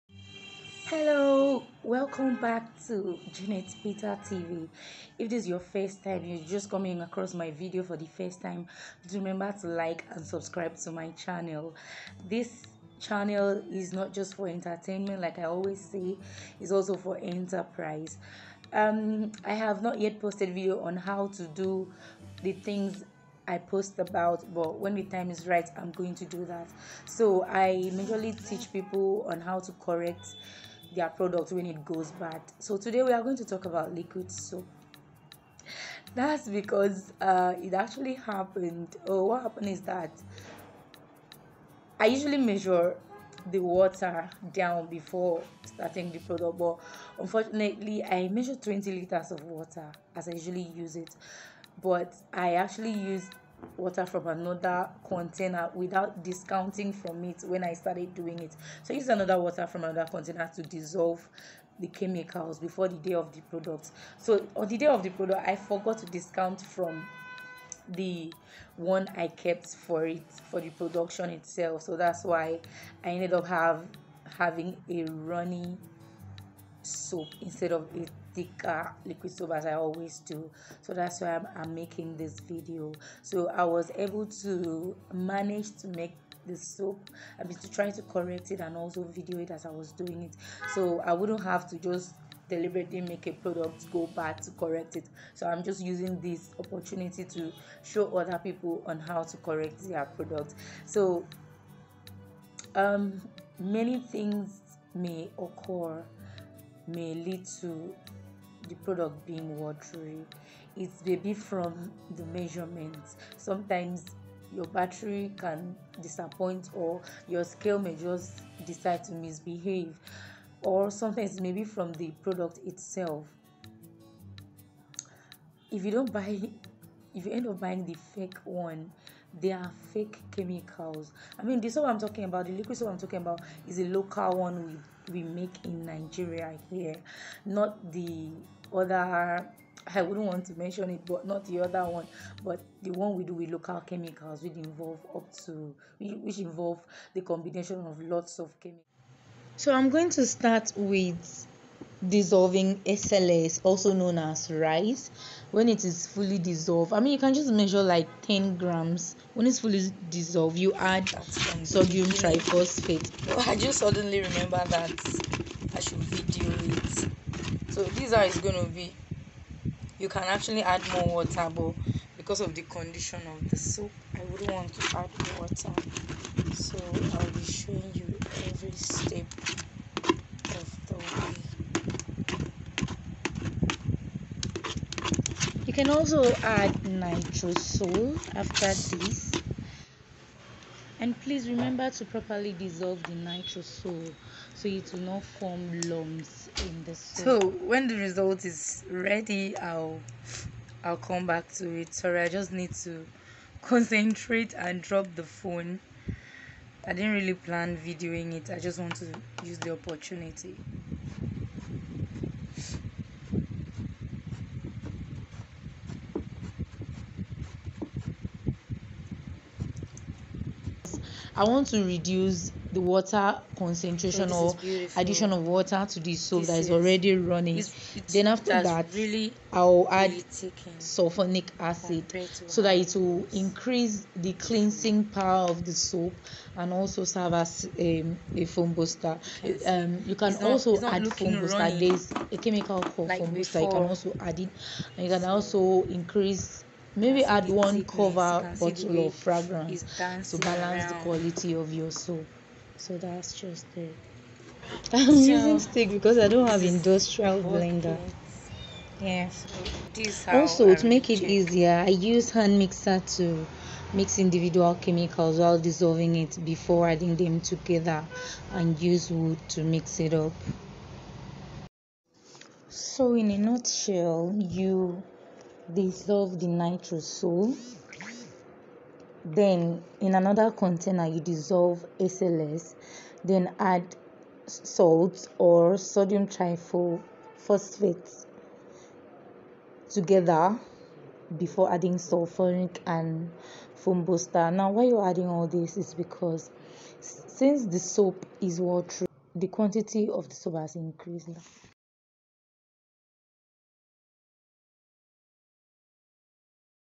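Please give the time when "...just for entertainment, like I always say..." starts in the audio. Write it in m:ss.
0:14.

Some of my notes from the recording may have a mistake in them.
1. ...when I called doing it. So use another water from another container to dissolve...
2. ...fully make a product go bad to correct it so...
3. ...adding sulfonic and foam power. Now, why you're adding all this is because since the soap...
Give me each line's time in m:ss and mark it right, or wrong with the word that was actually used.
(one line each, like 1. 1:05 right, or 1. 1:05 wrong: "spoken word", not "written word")
1. 0:57 wrong: "started", not "called"
2. 1:32 wrong: "deliberately", not "fully"
3. 4:51 wrong: "booster", not "power".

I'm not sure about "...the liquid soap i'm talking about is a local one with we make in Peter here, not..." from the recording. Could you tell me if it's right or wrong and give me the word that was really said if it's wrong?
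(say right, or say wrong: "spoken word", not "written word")
wrong: "Nigeria", not "Peter".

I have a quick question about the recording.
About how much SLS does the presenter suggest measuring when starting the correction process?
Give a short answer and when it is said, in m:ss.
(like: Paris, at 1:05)
10 grams, at 2:38.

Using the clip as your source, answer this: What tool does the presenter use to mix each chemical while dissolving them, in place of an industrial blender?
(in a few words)
hand mixer.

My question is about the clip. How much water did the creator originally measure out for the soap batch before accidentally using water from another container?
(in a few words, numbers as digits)
20 liters.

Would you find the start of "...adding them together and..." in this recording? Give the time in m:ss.
4:26.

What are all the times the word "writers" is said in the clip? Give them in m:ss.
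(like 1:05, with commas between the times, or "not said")
not said.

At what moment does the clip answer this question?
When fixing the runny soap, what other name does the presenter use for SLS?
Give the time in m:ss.
2:34.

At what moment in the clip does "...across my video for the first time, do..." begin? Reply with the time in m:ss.
0:06.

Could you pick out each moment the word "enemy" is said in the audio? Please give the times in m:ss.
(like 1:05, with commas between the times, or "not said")
not said.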